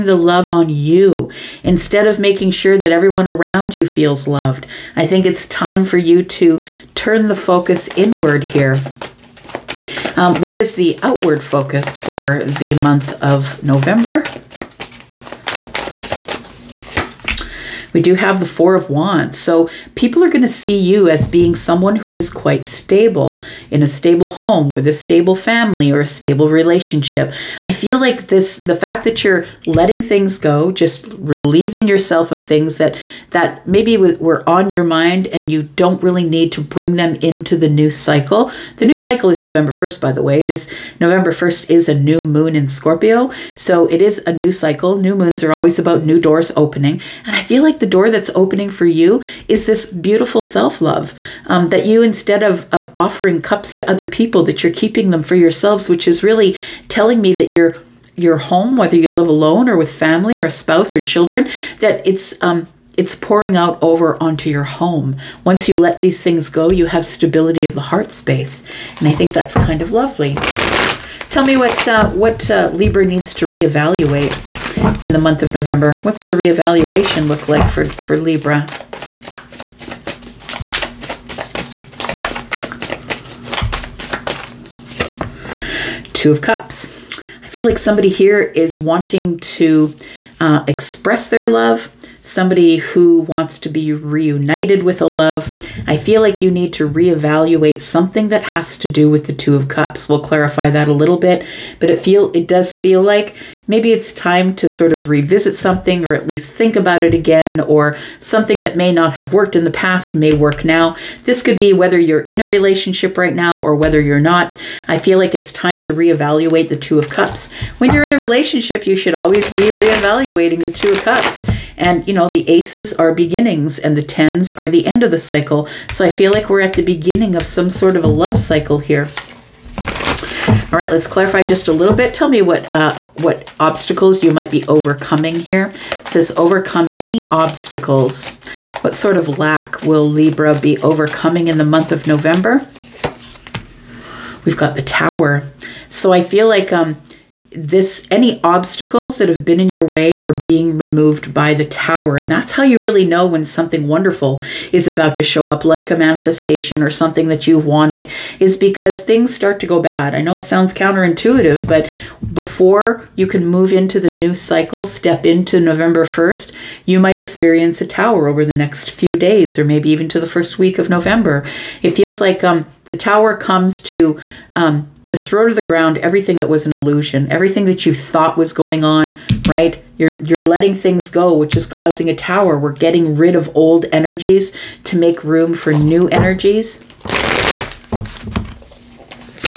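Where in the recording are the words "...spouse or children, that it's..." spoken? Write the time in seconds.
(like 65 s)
60 s.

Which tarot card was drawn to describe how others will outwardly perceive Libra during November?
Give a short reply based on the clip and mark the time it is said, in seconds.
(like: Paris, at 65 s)
Four of Wands, at 18 s.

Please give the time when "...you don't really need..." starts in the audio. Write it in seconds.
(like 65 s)
35 s.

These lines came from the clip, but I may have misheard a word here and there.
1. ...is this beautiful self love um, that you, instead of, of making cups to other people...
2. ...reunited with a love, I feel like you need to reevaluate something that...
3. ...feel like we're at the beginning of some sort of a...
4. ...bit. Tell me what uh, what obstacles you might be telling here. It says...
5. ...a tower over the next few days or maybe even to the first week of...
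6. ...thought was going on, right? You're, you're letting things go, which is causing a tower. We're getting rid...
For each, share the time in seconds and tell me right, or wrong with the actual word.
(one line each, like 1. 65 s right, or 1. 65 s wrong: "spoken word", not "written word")
1. 49 s wrong: "offering", not "making"
2. 93 s right
3. 126 s right
4. 131 s wrong: "overcoming", not "telling"
5. 167 s right
6. 177 s right.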